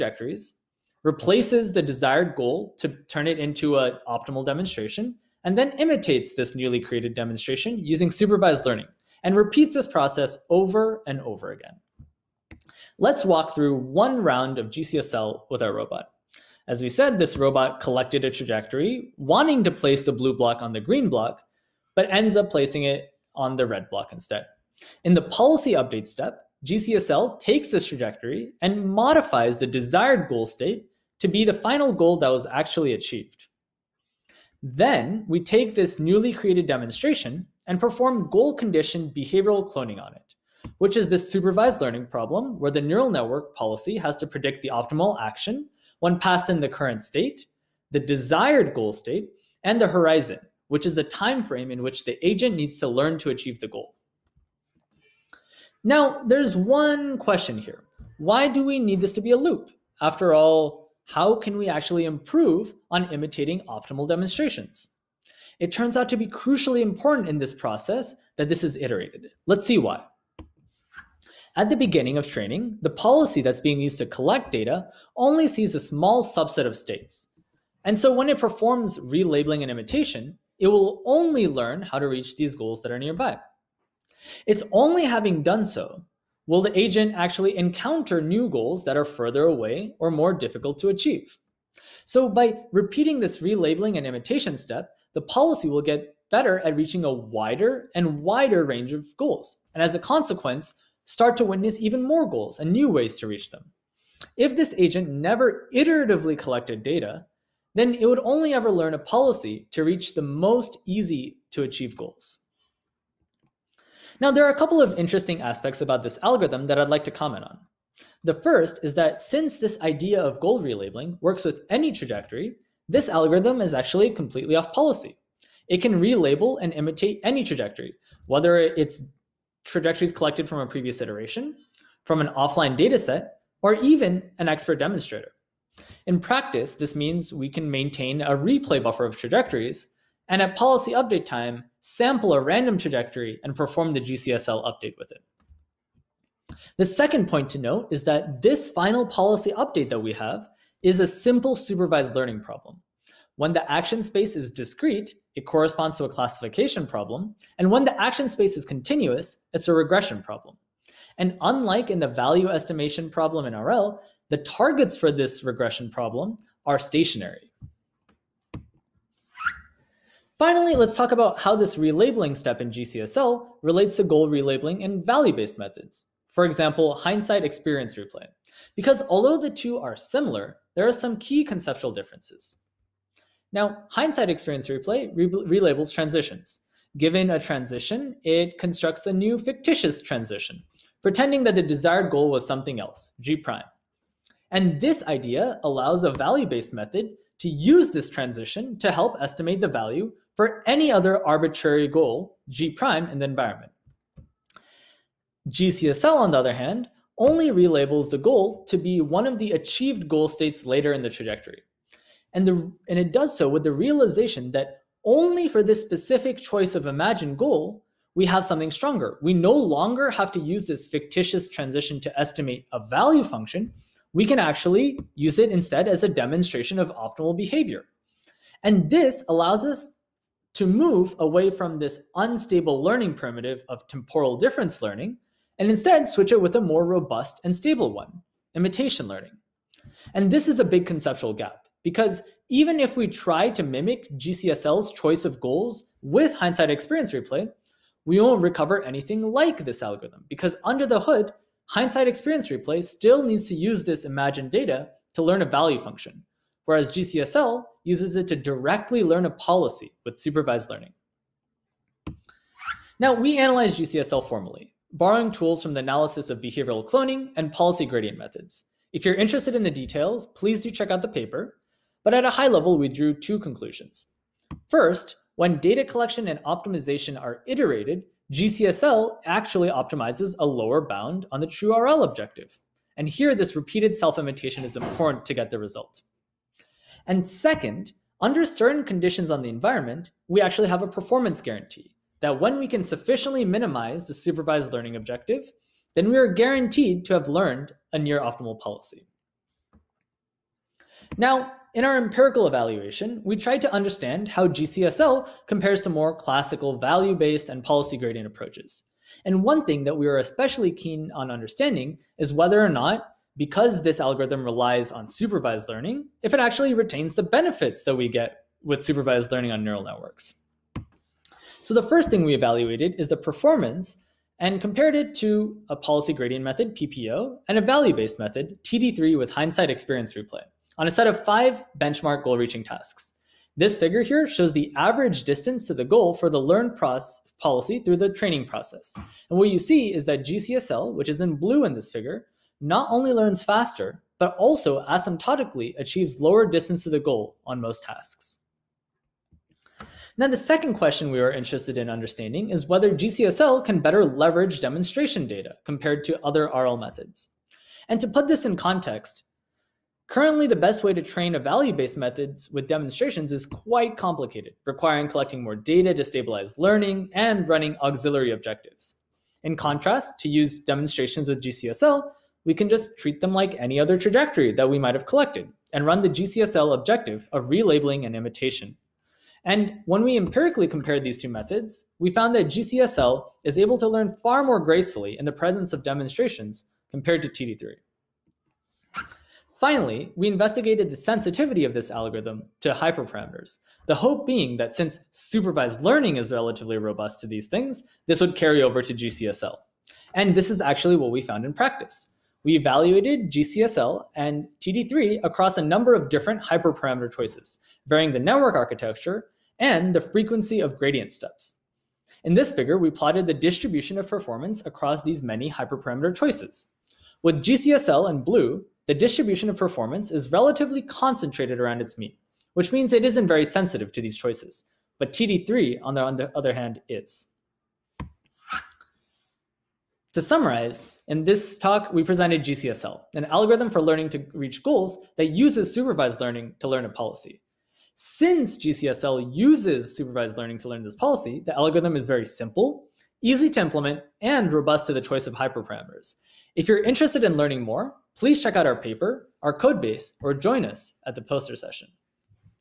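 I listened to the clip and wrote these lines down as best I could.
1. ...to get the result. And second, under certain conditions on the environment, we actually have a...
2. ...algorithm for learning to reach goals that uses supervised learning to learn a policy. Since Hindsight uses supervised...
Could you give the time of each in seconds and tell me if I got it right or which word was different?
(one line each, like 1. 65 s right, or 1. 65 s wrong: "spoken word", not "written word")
1. 285 s right
2. 433 s wrong: "GCSL", not "Hindsight".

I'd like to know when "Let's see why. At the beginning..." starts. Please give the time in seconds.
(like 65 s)
69 s.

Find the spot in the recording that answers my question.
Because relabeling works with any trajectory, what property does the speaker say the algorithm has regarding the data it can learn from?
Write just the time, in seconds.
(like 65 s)
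124 s.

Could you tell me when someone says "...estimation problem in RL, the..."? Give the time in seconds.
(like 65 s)
162 s.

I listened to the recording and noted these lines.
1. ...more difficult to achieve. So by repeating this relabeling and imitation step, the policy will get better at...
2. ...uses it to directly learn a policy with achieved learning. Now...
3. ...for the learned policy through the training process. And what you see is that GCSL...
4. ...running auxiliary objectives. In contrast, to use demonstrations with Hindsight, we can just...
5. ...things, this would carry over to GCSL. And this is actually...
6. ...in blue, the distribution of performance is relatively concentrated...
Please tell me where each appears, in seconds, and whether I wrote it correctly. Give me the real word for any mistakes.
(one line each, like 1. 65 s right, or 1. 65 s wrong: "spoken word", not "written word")
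1. 90 s right
2. 257 s wrong: "supervised", not "achieved"
3. 336 s right
4. 367 s wrong: "GCSL", not "Hindsight"
5. 397 s right
6. 418 s right.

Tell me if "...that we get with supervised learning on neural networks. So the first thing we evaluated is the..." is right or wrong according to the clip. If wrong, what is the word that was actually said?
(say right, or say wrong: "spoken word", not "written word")
right.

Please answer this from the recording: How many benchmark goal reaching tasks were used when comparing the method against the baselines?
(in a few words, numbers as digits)
5.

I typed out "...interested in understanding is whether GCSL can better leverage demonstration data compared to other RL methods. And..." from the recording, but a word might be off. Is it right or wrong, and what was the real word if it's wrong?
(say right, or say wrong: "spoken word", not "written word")
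right.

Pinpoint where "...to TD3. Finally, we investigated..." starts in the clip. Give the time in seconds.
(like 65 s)
387 s.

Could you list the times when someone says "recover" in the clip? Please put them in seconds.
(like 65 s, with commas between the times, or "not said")
248 s.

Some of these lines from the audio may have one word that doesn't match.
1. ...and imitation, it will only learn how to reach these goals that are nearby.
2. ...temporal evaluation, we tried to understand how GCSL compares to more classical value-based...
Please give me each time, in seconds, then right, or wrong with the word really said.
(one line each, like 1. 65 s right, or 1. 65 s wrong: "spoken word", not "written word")
1. 79 s right
2. 301 s wrong: "empirical", not "temporal".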